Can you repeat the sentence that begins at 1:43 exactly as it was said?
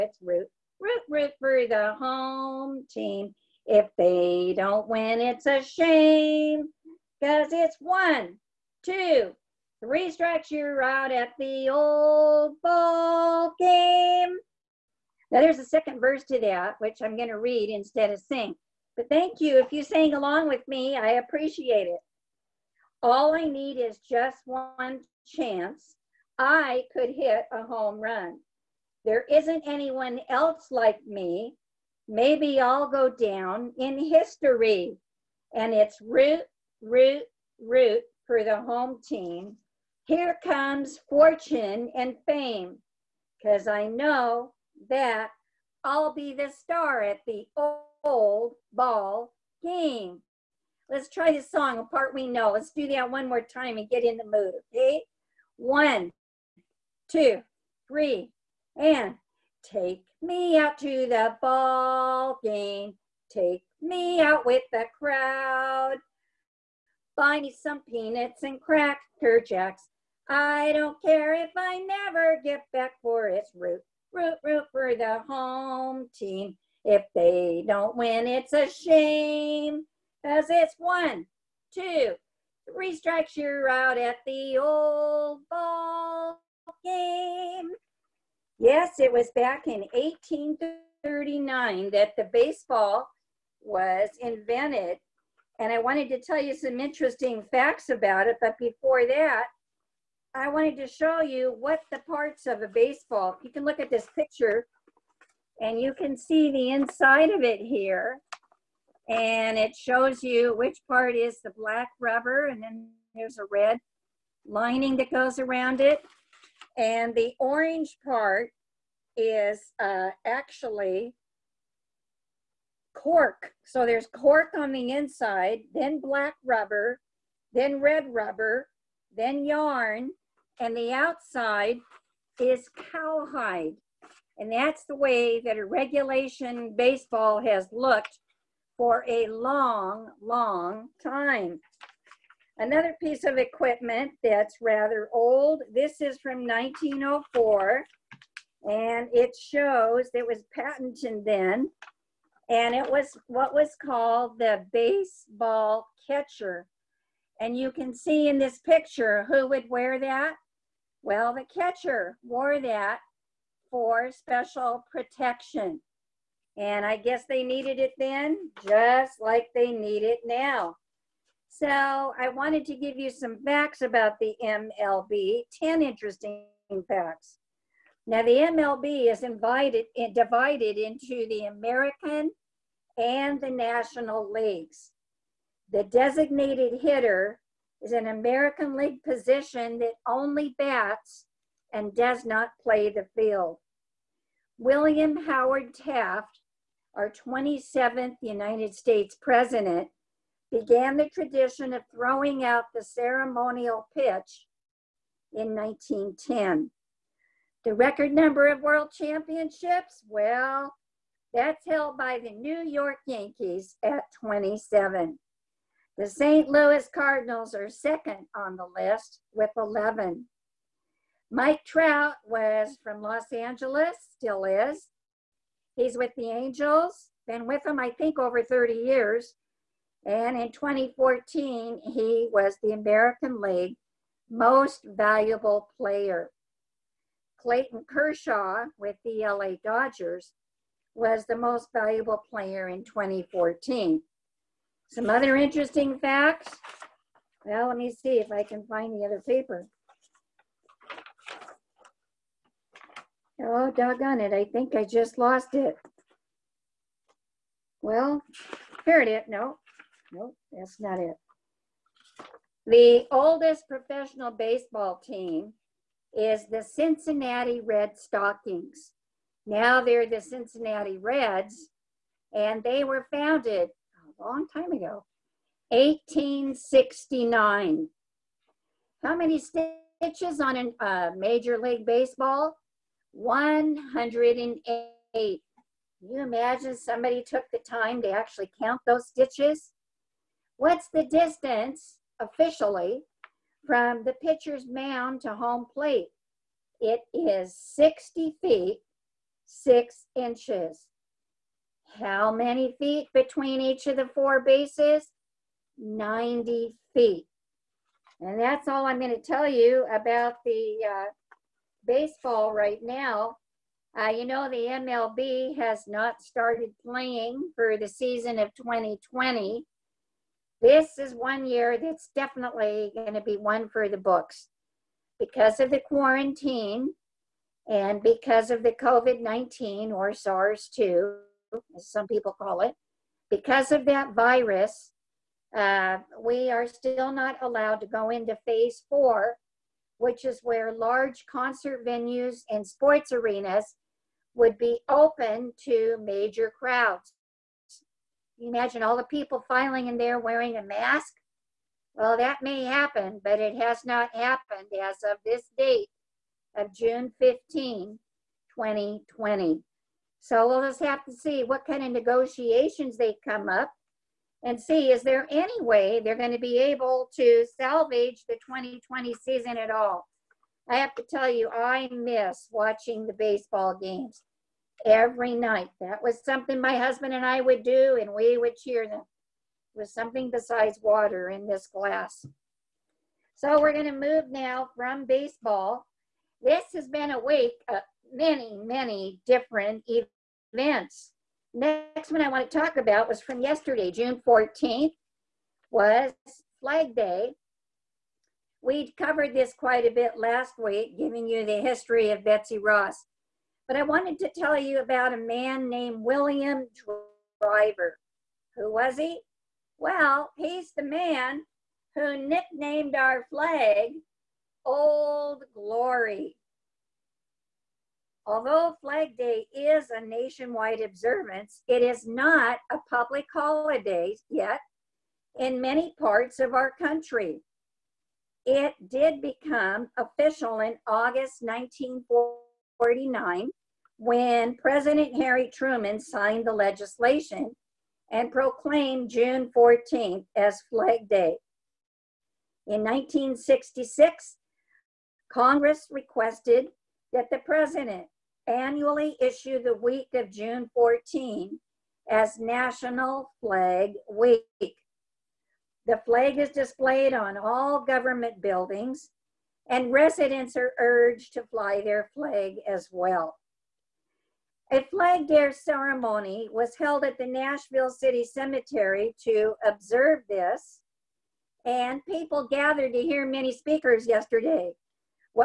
You can look at this picture and you can see the inside of it here.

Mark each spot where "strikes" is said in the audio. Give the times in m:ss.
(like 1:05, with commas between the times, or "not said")
0:10, 1:22.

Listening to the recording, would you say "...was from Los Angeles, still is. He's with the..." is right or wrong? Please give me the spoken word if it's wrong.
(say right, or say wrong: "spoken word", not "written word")
right.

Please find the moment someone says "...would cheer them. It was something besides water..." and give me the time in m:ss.
6:18.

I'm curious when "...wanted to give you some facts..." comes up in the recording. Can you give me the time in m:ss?
2:52.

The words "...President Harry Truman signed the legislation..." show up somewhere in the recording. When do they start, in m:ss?
7:14.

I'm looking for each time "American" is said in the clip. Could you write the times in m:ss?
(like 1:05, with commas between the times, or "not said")
3:01, 3:08, 3:52.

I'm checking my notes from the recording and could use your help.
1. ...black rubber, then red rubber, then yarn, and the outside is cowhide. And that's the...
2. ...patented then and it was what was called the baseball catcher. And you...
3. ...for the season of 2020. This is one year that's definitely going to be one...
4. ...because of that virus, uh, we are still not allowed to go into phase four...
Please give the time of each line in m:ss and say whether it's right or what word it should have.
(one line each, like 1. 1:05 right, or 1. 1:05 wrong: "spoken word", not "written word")
1. 2:06 right
2. 2:30 right
3. 5:17 right
4. 5:33 right.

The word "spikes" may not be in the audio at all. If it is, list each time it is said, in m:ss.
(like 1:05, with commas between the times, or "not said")
not said.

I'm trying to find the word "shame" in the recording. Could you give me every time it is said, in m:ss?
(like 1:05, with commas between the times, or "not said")
0:05, 1:18.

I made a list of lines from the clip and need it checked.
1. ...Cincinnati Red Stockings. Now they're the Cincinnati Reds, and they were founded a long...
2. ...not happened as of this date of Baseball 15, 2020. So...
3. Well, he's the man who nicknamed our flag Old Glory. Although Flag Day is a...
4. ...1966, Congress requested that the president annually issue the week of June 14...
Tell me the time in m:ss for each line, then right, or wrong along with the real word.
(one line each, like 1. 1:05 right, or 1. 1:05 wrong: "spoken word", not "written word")
1. 4:26 right
2. 5:53 wrong: "June", not "Baseball"
3. 6:49 right
4. 7:22 right.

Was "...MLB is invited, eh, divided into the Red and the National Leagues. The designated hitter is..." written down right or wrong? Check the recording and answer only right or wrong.
wrong.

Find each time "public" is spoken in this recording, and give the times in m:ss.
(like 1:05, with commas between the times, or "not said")
7:02.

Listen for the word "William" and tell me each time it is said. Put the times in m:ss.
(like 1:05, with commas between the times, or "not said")
3:14, 6:46.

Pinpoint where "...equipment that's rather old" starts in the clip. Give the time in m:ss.
2:23.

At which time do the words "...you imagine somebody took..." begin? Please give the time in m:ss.
4:46.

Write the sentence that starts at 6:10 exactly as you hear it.
I have to tell you, I miss watching the baseball games every night.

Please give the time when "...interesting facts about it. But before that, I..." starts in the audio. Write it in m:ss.
1:36.